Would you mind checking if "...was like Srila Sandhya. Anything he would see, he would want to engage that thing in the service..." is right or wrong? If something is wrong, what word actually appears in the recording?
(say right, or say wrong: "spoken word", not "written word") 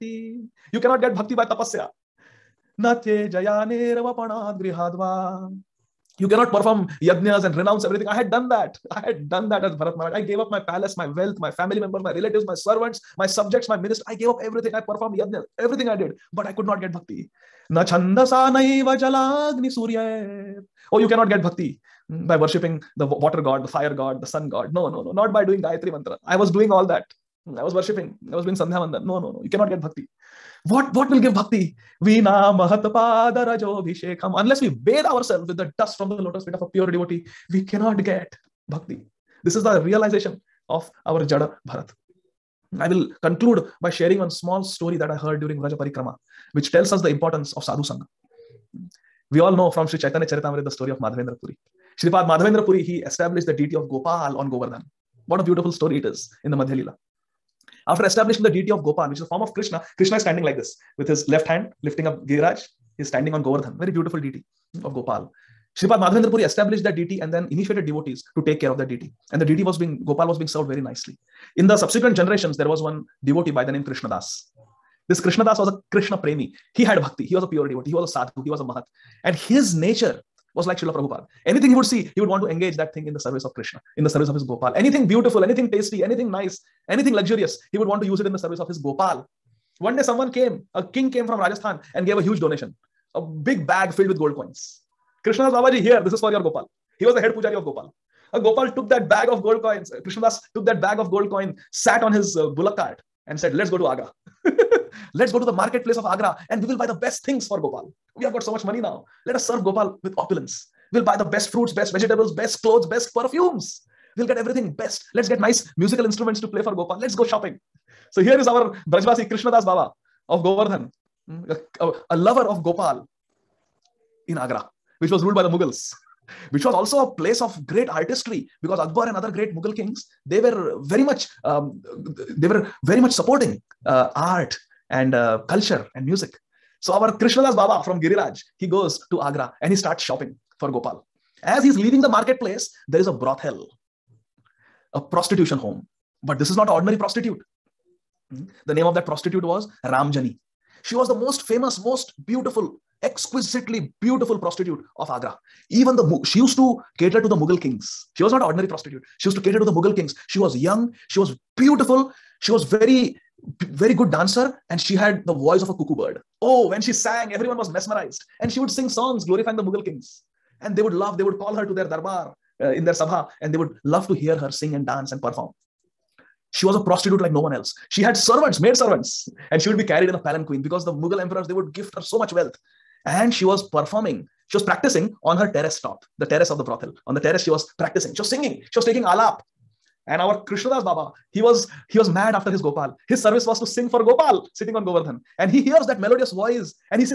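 wrong: "Prabhupada", not "Sandhya".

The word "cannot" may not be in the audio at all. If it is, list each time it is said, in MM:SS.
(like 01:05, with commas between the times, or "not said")
00:00, 00:06, 00:21, 00:29, 00:37.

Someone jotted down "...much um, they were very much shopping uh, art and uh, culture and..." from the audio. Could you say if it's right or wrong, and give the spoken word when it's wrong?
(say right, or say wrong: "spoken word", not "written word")
wrong: "supporting", not "shopping".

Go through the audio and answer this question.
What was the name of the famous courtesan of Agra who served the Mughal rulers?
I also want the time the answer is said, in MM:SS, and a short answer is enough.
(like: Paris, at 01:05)
Ramjani, at 02:29.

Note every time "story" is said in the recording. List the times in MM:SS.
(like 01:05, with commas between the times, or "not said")
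00:44, 00:50, 00:55.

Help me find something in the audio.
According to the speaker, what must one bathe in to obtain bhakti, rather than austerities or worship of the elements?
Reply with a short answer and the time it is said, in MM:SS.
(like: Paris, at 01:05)
Dust from the lotus feet of a pure devotee, at 00:35.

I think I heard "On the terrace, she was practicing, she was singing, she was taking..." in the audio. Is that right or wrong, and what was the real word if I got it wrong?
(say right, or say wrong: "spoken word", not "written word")
right.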